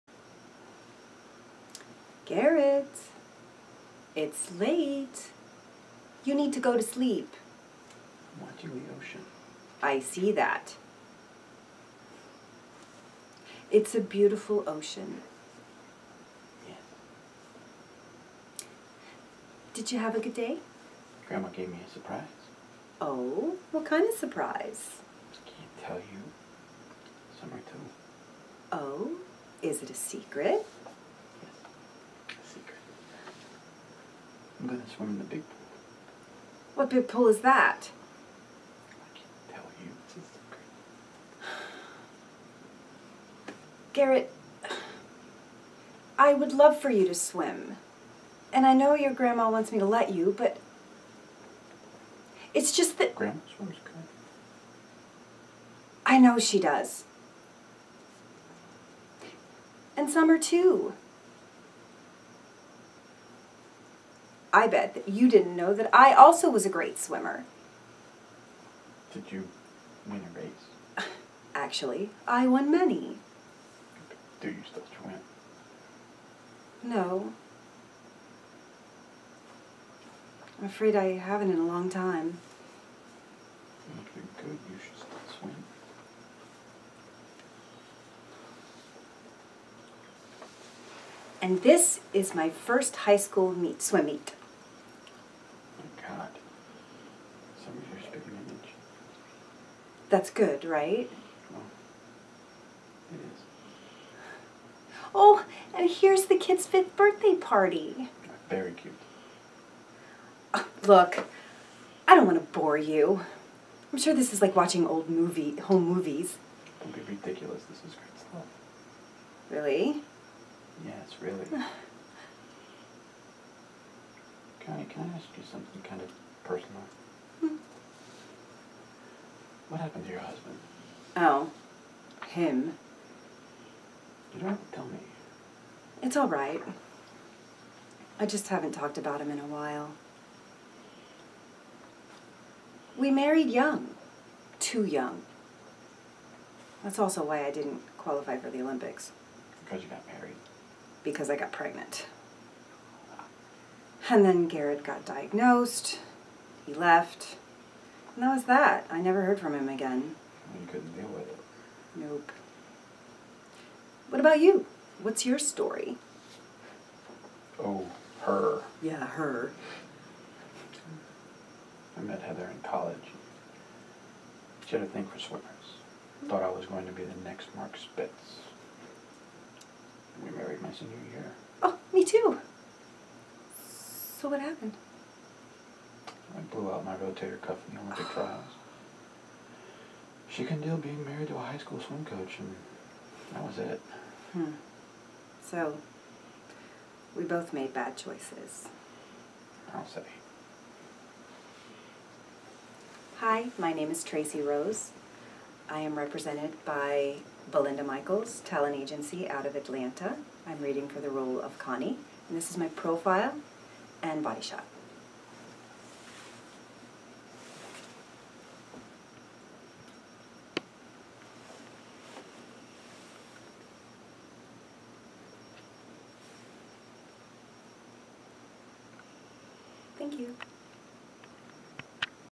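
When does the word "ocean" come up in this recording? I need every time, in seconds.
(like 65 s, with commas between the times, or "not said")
8 s, 14 s.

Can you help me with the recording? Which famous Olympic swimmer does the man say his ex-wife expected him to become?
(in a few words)
Mark Spitz.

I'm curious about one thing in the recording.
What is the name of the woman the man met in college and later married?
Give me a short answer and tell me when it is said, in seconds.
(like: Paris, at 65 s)
Heather, at 172 s.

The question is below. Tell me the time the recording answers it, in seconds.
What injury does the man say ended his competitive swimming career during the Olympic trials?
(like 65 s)
186 s.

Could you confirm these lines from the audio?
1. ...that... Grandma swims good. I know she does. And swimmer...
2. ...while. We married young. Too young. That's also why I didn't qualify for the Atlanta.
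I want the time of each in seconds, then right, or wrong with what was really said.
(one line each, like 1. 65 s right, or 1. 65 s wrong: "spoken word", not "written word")
1. 52 s wrong: "summer", not "swimmer"
2. 139 s wrong: "Olympics", not "Atlanta".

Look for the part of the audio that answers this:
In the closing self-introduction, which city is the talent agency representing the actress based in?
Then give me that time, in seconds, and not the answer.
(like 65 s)
209 s.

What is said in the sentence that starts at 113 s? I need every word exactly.
I'm sure this is like watching old movie home movies.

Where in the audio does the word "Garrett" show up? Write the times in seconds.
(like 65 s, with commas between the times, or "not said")
2 s, 43 s, 154 s.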